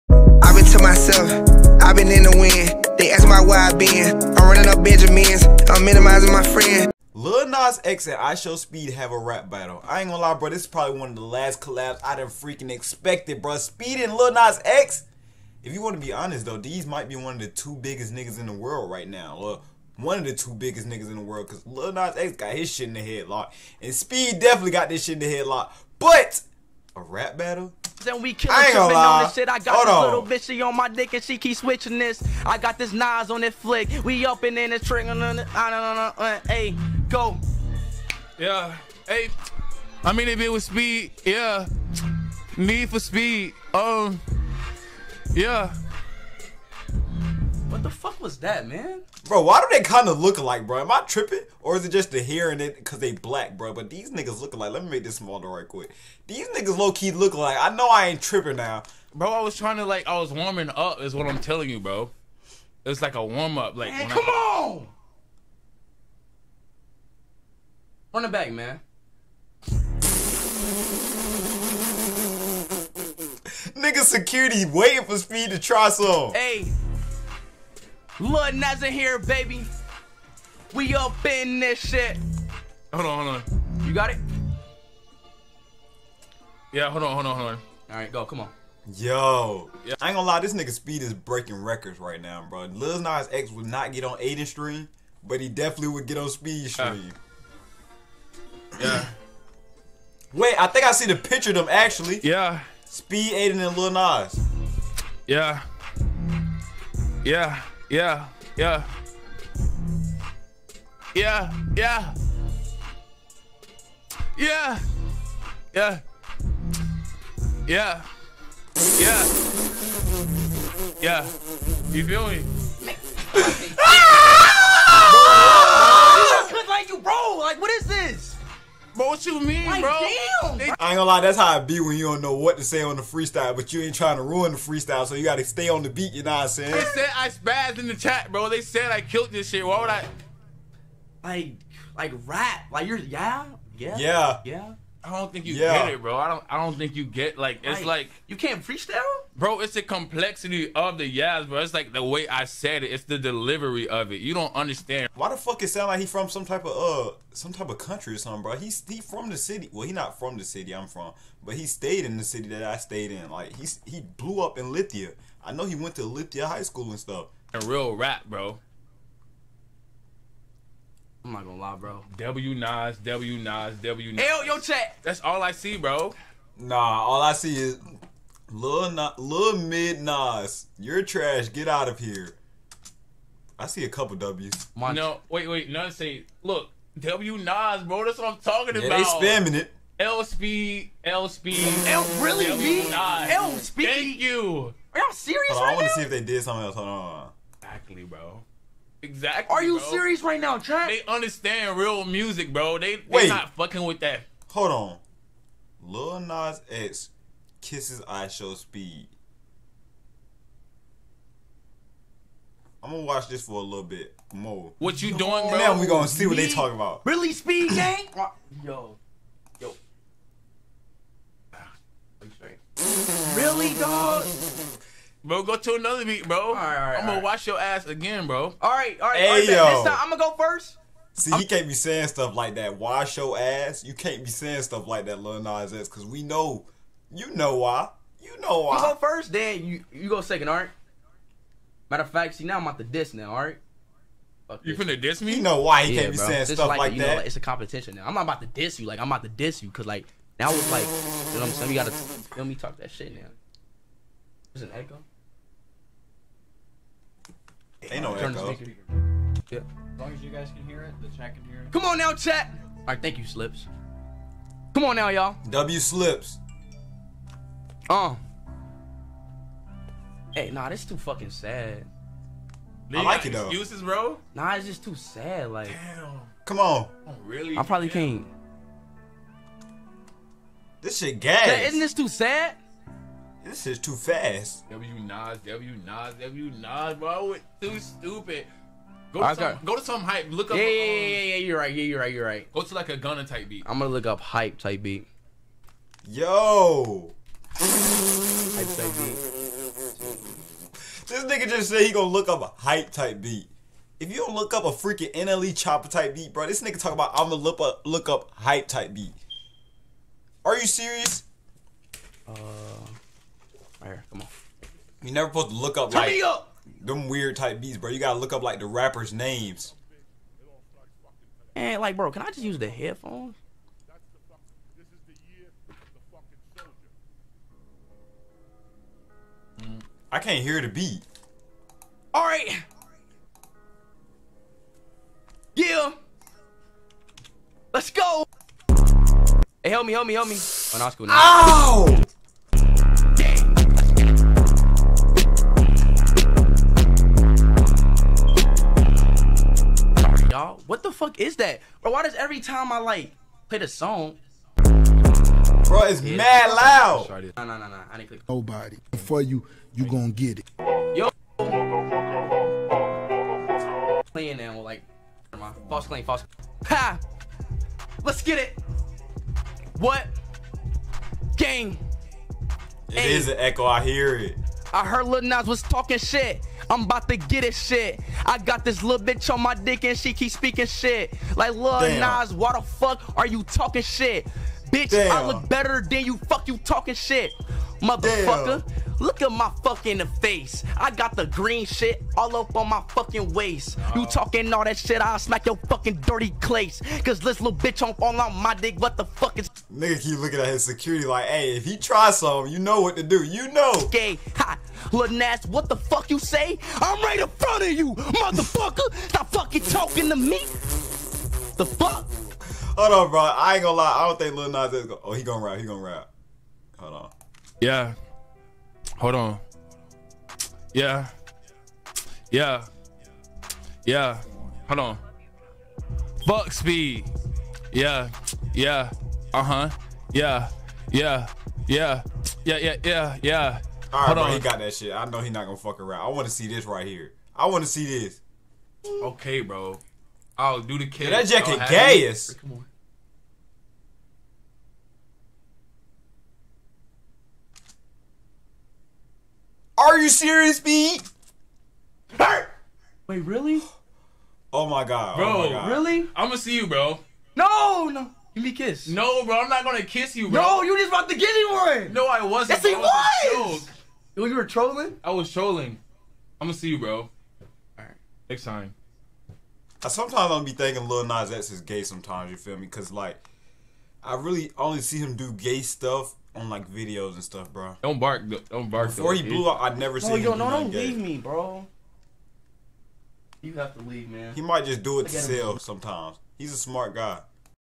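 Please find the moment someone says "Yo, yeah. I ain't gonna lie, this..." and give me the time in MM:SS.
01:28.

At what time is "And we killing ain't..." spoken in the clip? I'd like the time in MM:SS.
00:28.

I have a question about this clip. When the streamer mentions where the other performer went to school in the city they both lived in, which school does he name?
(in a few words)
Lithia High School.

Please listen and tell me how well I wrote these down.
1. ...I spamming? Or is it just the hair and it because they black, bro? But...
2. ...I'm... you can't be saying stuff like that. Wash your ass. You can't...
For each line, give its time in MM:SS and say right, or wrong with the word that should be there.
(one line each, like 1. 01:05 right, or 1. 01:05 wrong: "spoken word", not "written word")
1. 00:50 wrong: "tripping", not "spamming"
2. 03:51 right.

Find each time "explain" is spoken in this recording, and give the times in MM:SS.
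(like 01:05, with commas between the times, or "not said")
not said.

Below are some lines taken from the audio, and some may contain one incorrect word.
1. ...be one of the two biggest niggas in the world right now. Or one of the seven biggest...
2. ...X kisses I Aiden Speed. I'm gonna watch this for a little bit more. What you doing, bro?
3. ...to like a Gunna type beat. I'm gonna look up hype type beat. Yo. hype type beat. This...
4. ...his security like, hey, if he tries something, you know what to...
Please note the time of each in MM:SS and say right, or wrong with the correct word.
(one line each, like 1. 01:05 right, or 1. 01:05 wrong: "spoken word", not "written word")
1. 00:17 wrong: "two", not "seven"
2. 03:26 wrong: "Show", not "Aiden"
3. 04:52 right
4. 06:40 right.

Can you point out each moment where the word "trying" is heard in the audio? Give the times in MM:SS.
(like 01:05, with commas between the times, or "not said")
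00:59, 02:13.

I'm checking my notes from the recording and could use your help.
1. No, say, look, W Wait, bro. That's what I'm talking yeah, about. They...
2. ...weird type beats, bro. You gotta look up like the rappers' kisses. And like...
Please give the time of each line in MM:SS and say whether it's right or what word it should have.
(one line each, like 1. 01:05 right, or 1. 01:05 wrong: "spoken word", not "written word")
1. 03:05 wrong: "Nas", not "Wait"
2. 05:17 wrong: "names", not "kisses".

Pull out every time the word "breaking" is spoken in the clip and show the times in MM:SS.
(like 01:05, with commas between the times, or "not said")
01:31.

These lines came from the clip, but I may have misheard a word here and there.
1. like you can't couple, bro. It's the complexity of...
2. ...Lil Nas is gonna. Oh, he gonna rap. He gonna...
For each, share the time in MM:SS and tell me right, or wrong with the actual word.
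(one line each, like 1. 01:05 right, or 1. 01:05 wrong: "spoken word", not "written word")
1. 02:27 wrong: "freestyle", not "couple"
2. 06:54 right.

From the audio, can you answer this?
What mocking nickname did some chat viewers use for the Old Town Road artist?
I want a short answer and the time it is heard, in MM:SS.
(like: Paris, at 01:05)
Lil Mid Nas, at 02:59.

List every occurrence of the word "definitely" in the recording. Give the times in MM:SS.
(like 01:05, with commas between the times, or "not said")
00:24, 01:35.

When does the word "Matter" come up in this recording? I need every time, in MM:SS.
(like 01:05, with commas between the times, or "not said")
04:01.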